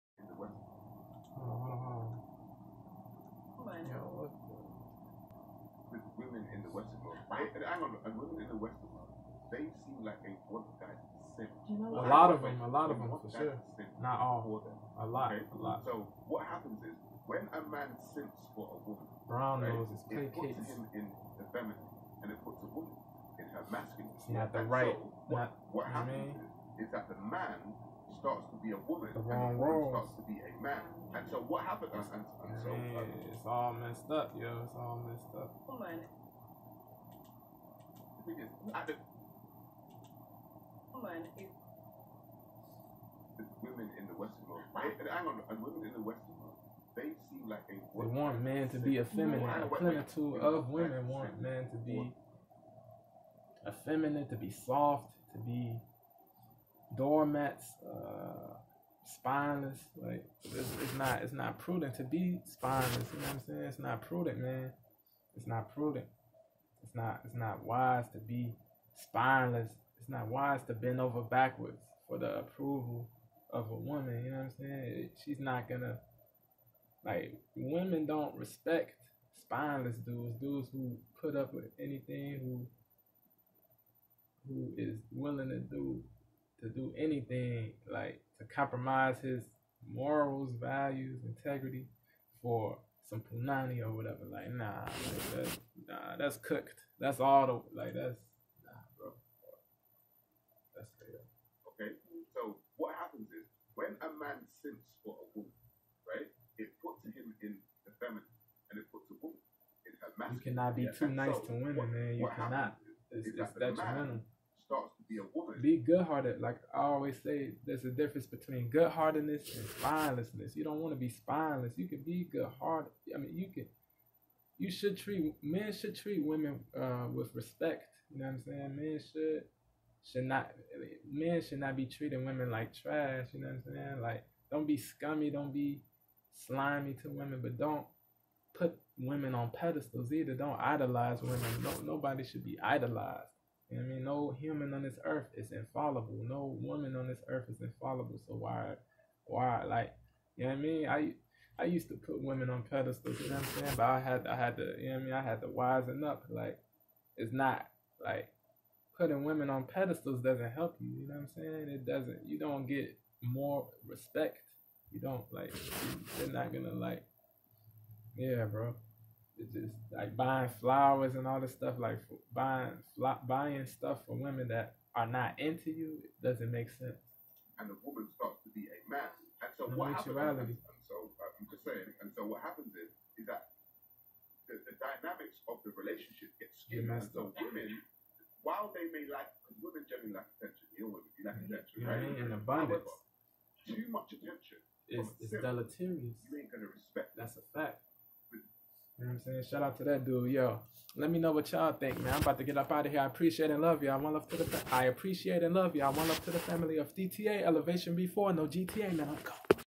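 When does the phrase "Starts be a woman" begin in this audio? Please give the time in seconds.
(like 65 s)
114 s.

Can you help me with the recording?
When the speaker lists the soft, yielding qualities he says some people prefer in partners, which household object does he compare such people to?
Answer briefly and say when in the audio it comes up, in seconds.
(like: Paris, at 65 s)
doormats, at 56 s.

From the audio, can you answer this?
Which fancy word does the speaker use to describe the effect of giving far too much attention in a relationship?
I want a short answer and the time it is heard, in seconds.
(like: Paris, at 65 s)
deleterious, at 195 s.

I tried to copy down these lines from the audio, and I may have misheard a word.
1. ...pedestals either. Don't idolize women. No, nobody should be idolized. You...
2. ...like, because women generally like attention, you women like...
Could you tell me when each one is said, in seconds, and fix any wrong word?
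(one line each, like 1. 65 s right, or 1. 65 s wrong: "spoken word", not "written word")
1. 139 s right
2. 189 s right.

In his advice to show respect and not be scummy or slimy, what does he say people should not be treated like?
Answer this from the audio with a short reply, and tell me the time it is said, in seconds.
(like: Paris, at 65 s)
trash, at 132 s.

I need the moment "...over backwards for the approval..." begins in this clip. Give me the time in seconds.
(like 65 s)
70 s.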